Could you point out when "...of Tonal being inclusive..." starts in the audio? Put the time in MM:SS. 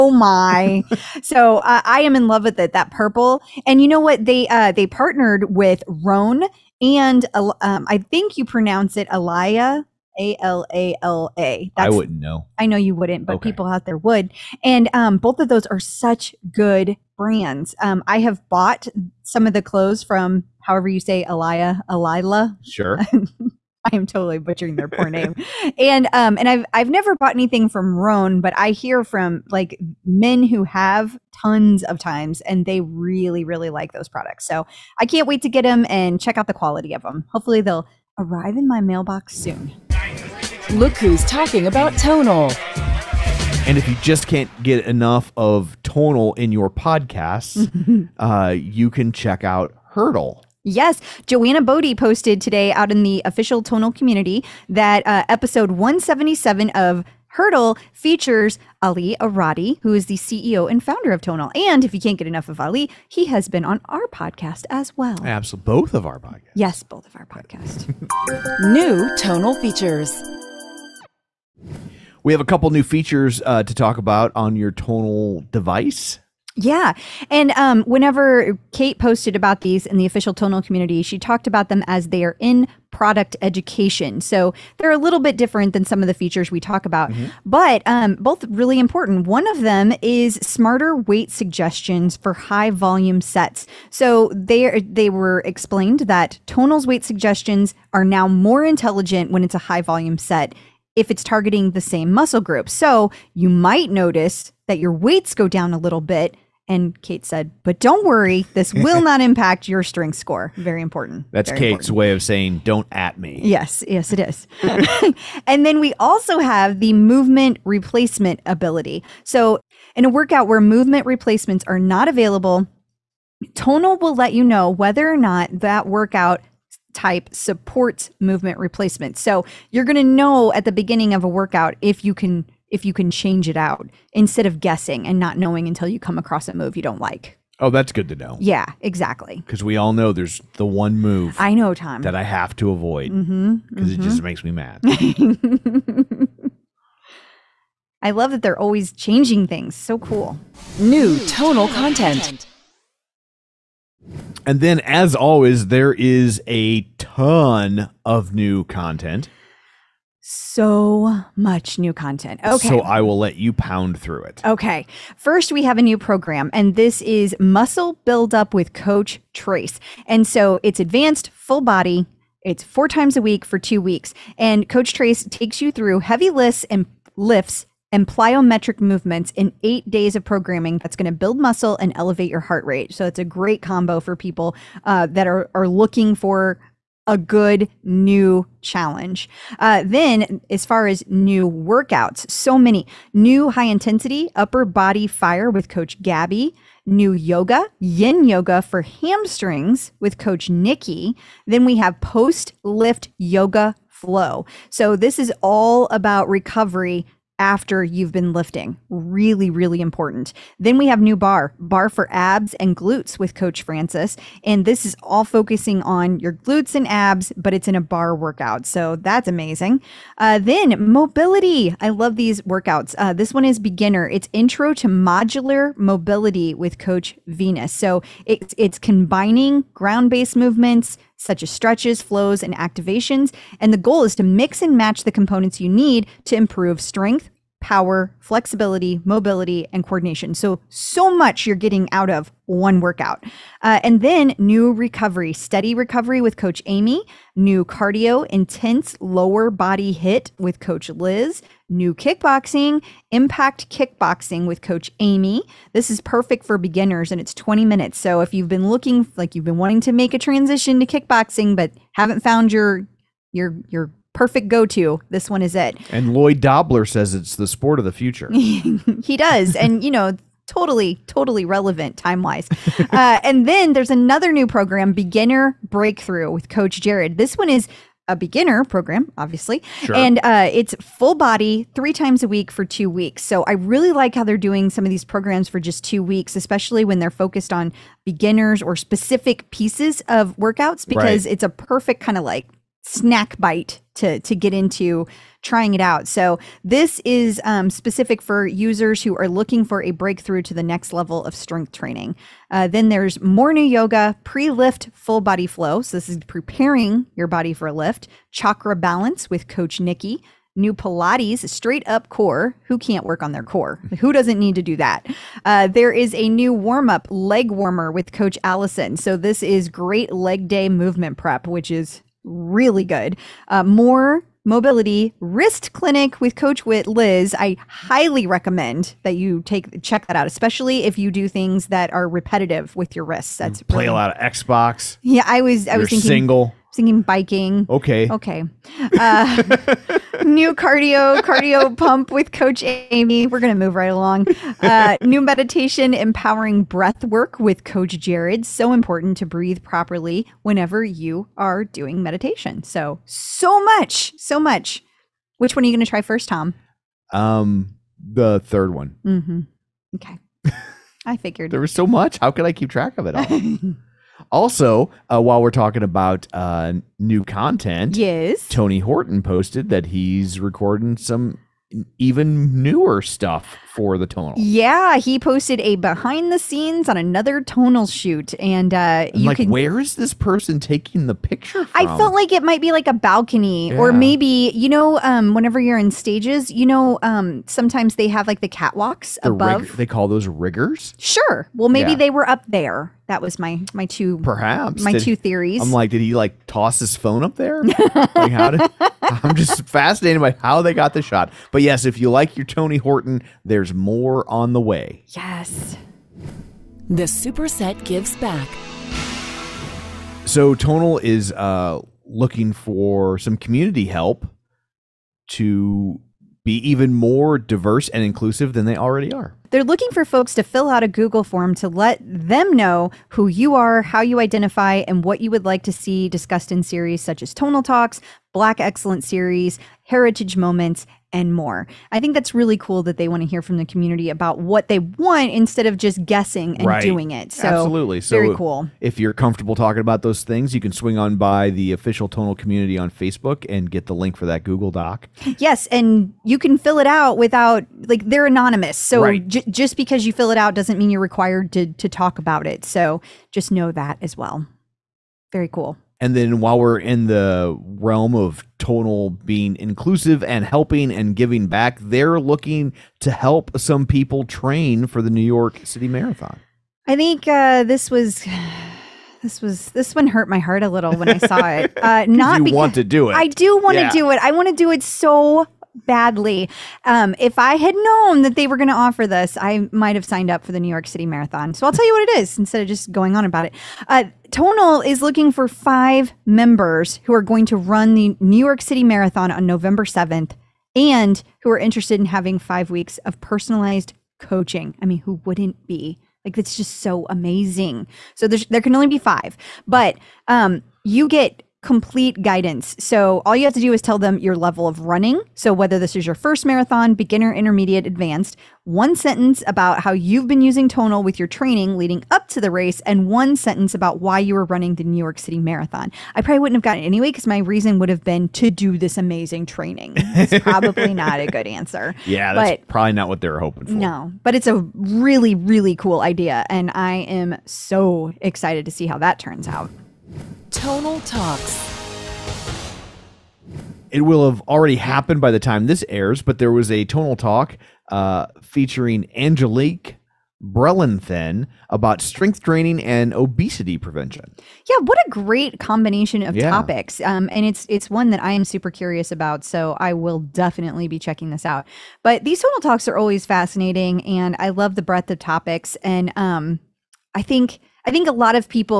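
07:38.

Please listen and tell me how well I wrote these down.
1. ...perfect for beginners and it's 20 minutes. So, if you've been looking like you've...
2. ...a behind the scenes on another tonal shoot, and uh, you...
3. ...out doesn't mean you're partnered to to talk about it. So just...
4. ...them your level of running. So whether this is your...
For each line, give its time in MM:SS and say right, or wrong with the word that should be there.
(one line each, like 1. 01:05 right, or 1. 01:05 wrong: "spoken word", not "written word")
1. 04:16 right
2. 06:15 right
3. 07:30 wrong: "required", not "partnered"
4. 08:23 right.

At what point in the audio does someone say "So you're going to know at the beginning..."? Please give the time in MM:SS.
02:09.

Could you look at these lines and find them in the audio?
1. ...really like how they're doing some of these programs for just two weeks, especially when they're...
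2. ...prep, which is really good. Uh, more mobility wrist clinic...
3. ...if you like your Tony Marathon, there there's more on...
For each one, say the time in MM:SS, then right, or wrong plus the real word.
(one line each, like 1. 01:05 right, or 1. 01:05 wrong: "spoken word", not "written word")
1. 04:43 right
2. 05:21 right
3. 06:41 wrong: "Horton", not "Marathon".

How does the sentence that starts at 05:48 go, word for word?
So important to breathe properly whenever you are doing meditation.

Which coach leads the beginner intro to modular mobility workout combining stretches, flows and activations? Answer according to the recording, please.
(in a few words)
Coach Venus.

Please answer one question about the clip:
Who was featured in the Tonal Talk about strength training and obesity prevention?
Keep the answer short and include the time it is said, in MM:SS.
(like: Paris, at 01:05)
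Angelique Brellenthin, at 08:59.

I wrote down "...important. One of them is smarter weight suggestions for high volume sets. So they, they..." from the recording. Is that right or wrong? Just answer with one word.
right.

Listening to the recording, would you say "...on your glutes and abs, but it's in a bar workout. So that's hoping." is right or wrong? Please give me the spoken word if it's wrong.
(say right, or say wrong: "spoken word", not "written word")
wrong: "amazing", not "hoping".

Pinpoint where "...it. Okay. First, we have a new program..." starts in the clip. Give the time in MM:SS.
02:44.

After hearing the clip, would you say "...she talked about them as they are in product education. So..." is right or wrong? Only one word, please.
right.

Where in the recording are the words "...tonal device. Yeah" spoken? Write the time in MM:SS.
01:14.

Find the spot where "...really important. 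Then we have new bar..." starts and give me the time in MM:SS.
03:29.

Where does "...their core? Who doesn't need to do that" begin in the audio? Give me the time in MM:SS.
05:13.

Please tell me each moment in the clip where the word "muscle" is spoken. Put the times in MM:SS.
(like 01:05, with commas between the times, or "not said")
01:42, 02:47, 03:01.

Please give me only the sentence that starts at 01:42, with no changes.
So you might notice that your weights go down a little bit.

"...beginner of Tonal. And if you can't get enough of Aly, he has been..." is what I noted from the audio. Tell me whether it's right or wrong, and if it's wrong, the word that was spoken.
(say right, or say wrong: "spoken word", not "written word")
wrong: "founder", not "beginner".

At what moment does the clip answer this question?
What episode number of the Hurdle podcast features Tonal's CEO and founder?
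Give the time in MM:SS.
00:55.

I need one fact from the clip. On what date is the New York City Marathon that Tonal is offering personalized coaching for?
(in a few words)
November 7.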